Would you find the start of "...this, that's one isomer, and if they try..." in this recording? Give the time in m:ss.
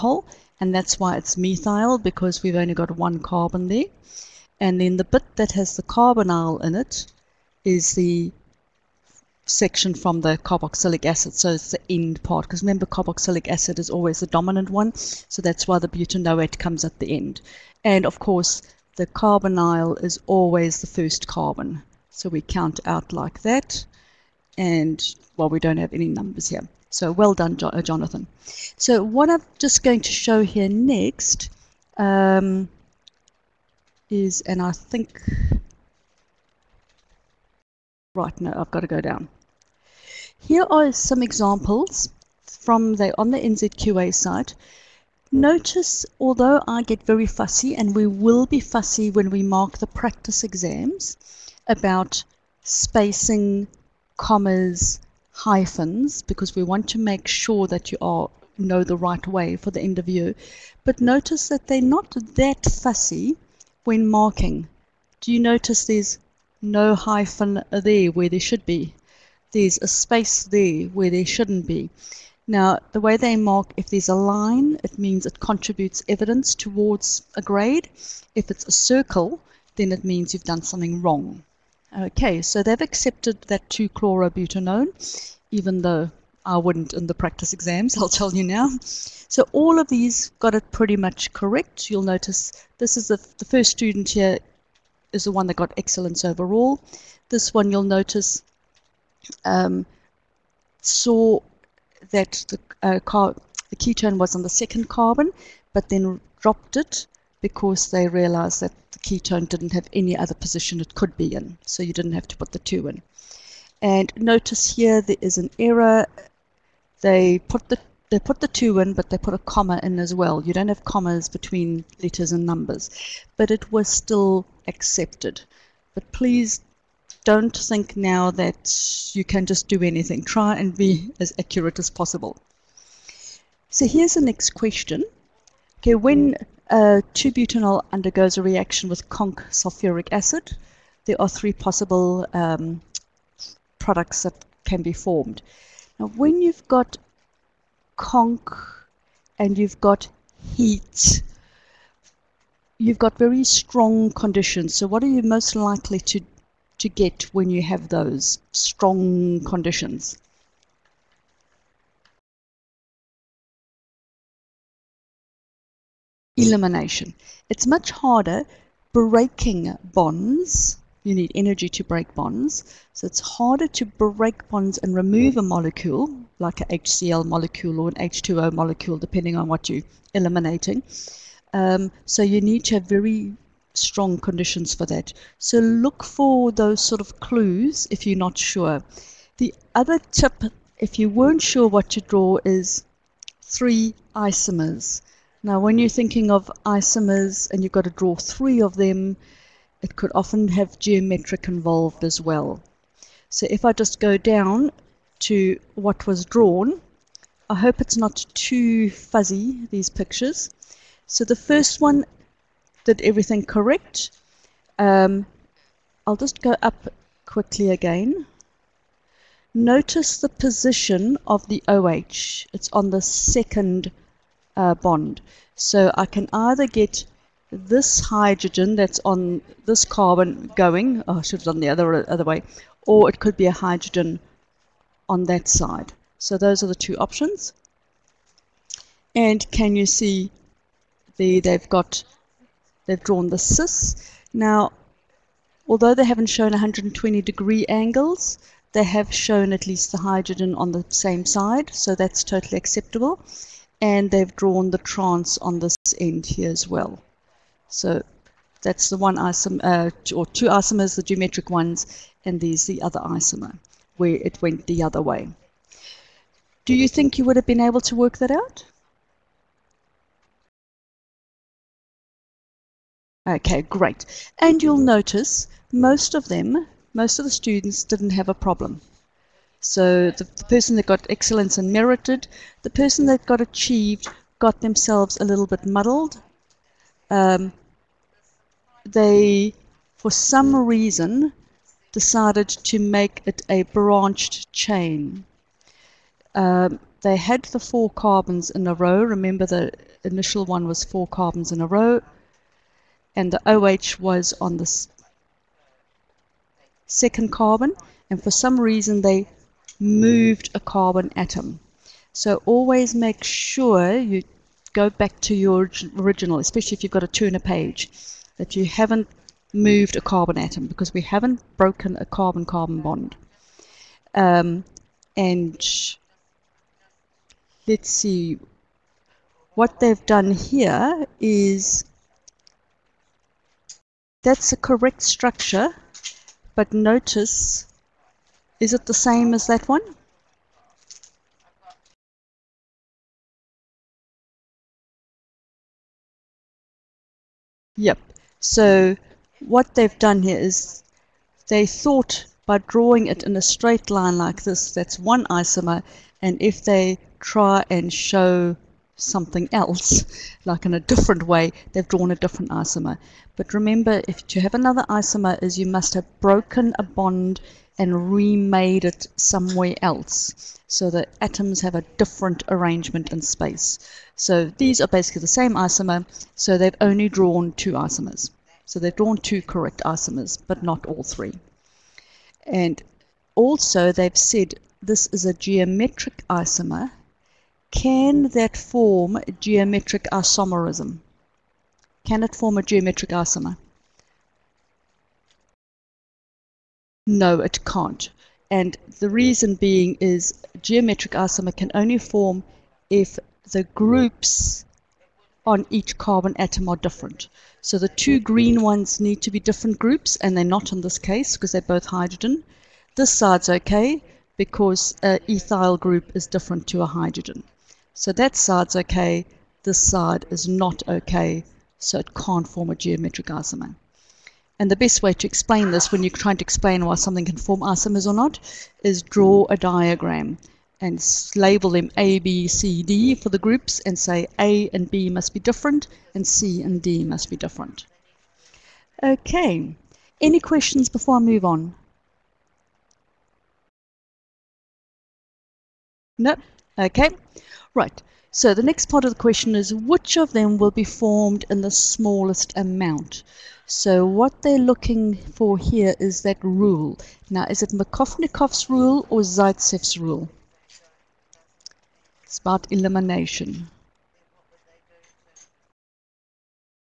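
5:54.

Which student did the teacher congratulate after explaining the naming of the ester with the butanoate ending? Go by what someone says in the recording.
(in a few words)
Jonathan.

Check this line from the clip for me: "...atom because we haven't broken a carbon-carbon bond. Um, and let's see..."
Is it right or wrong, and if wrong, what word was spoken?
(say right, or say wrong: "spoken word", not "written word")
right.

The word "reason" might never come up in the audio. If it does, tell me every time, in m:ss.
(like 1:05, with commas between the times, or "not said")
4:50, 5:08, 6:39.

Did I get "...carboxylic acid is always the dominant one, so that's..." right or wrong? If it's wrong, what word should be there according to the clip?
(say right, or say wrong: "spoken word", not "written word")
right.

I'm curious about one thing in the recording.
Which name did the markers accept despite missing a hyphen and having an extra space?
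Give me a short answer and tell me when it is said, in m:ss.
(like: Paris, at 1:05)
2-chlorobutanone, at 1:23.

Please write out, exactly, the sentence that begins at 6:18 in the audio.
So they've drawn two correct isomers, but not all three.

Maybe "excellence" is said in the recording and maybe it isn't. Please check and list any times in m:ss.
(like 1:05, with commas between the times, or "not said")
1:35, 4:41.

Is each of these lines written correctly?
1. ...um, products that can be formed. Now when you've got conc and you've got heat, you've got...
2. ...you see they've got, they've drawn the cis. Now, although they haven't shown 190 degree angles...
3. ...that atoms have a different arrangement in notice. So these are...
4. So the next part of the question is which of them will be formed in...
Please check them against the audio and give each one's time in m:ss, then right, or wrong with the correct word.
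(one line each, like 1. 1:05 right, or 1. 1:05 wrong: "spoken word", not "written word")
1. 2:22 right
2. 3:59 wrong: "120", not "190"
3. 6:10 wrong: "space", not "notice"
4. 7:28 right.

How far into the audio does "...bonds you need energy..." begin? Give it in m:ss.
2:49.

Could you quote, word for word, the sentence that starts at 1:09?
There's a space there where there shouldn't be.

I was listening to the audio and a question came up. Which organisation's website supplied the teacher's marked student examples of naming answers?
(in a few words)
NZQA.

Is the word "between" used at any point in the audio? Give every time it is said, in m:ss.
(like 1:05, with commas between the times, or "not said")
2:01.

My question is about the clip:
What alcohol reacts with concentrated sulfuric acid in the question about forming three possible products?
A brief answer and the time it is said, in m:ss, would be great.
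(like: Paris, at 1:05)
2-butanol, at 2:17.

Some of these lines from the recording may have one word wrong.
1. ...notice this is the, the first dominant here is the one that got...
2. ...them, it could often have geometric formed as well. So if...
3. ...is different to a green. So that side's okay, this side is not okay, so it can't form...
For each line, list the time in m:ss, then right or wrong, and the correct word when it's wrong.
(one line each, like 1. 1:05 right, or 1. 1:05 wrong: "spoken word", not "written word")
1. 1:32 wrong: "student", not "dominant"
2. 3:18 wrong: "involved", not "formed"
3. 6:56 wrong: "hydrogen", not "green".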